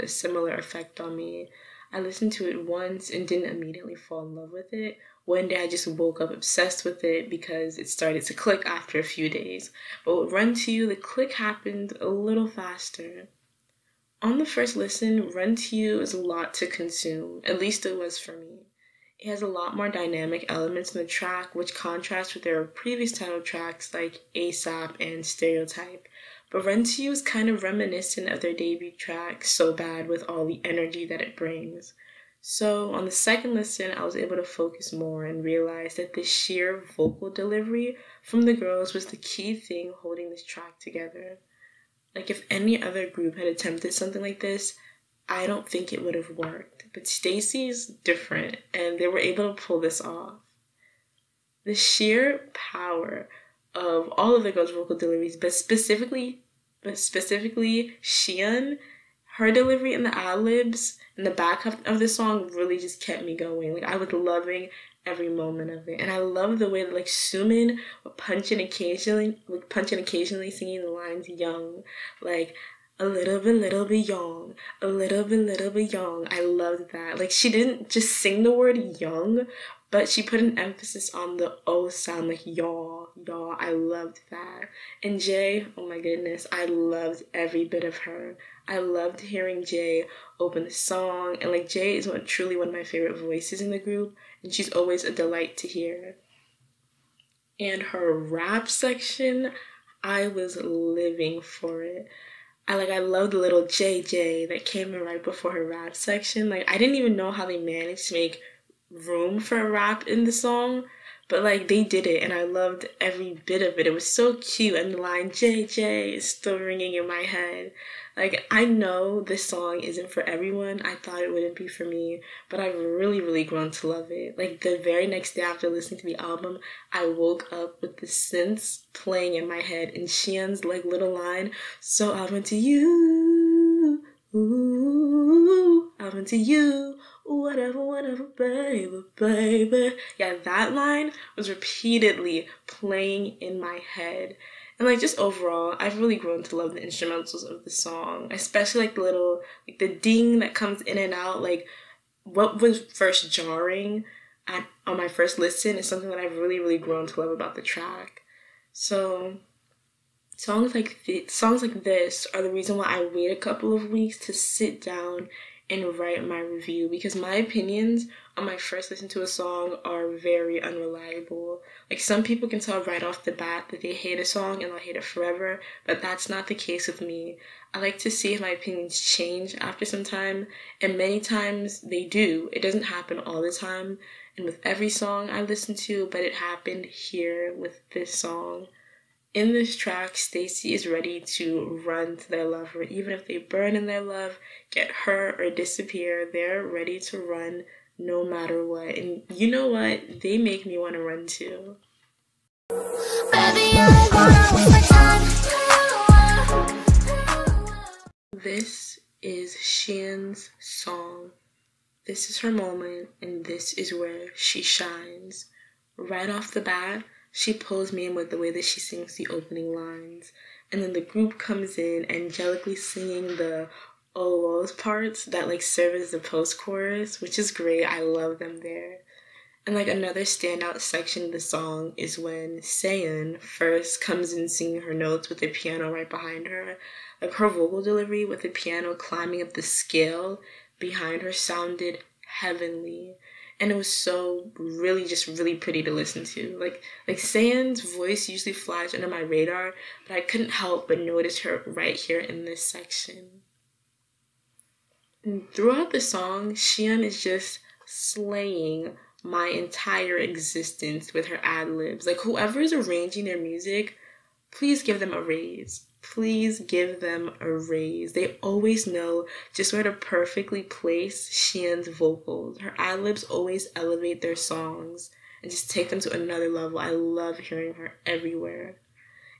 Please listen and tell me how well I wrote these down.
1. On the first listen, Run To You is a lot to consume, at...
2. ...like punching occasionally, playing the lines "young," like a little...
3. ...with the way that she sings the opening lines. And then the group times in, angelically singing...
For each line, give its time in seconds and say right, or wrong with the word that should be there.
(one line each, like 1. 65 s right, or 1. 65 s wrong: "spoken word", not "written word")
1. 14 s right
2. 69 s wrong: "singing", not "playing"
3. 218 s wrong: "comes", not "times".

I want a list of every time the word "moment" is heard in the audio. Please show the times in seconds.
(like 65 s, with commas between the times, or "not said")
65 s, 212 s.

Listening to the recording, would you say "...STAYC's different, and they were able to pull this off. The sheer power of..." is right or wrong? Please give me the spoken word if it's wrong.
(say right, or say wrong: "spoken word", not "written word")
right.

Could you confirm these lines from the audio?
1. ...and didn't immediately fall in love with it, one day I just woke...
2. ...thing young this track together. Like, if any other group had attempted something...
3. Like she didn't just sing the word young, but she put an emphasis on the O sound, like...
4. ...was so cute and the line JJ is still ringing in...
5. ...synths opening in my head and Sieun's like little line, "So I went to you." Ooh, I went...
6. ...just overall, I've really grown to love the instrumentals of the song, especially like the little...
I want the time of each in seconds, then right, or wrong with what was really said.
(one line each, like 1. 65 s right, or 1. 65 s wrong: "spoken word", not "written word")
1. 3 s right
2. 39 s wrong: "holding", not "young"
3. 77 s right
4. 113 s right
5. 128 s wrong: "playing", not "opening"
6. 145 s right.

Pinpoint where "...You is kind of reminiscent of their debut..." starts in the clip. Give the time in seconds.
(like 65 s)
27 s.